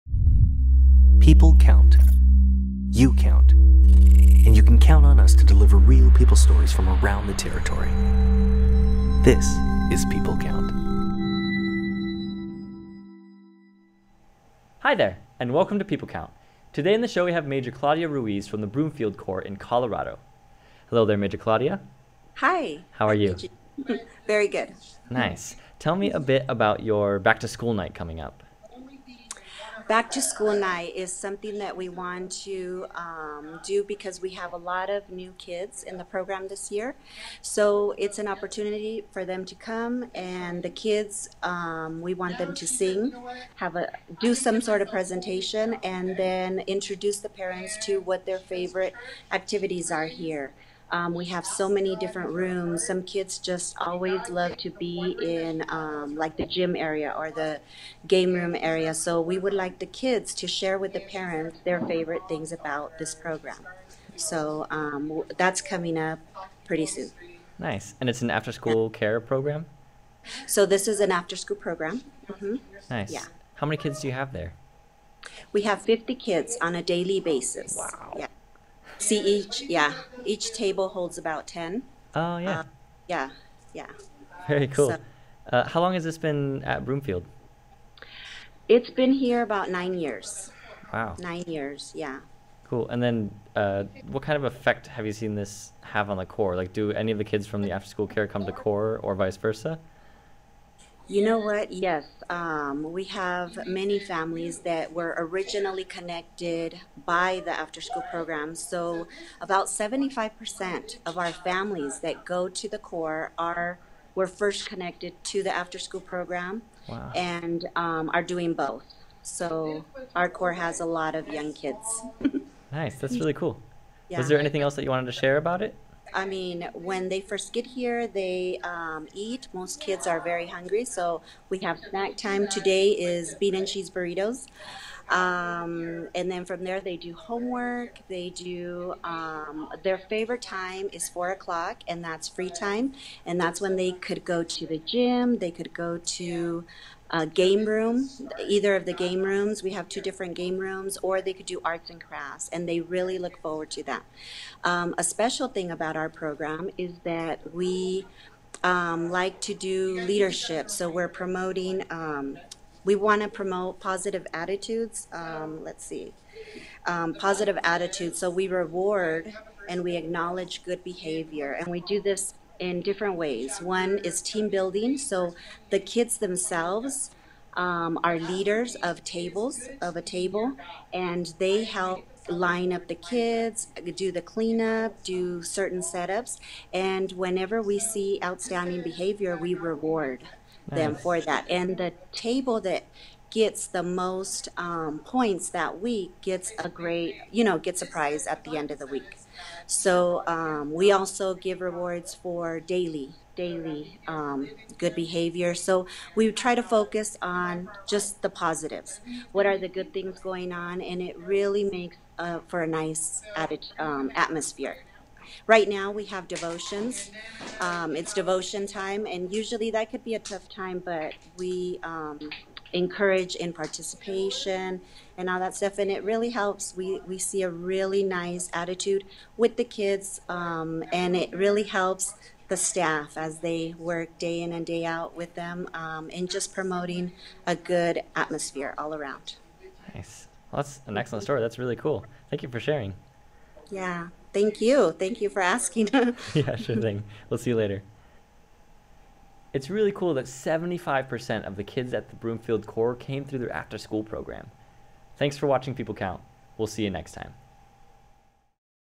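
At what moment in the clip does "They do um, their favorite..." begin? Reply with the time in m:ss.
2:18.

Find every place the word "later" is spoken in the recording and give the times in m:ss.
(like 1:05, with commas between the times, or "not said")
4:07.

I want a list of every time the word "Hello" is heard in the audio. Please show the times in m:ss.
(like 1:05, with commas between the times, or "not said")
0:20.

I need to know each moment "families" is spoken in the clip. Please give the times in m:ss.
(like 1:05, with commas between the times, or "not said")
1:43, 1:51.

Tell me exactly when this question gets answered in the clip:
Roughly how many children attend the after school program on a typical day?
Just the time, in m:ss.
1:15.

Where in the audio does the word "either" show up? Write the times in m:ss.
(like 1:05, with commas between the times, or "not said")
2:28.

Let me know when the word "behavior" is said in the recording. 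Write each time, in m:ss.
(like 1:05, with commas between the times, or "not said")
2:50, 3:08, 3:24.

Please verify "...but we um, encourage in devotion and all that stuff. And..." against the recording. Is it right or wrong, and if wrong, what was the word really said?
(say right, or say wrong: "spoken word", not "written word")
wrong: "participation", not "devotion".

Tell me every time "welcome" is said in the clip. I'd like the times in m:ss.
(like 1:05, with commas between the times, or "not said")
0:15.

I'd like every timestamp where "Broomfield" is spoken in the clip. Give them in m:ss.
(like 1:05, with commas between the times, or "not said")
0:18, 1:26, 4:12.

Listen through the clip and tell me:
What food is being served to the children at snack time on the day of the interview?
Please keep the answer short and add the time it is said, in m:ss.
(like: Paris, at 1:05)
Bean and cheese burritos, at 2:13.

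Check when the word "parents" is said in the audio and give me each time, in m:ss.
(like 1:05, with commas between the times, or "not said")
0:47, 1:00.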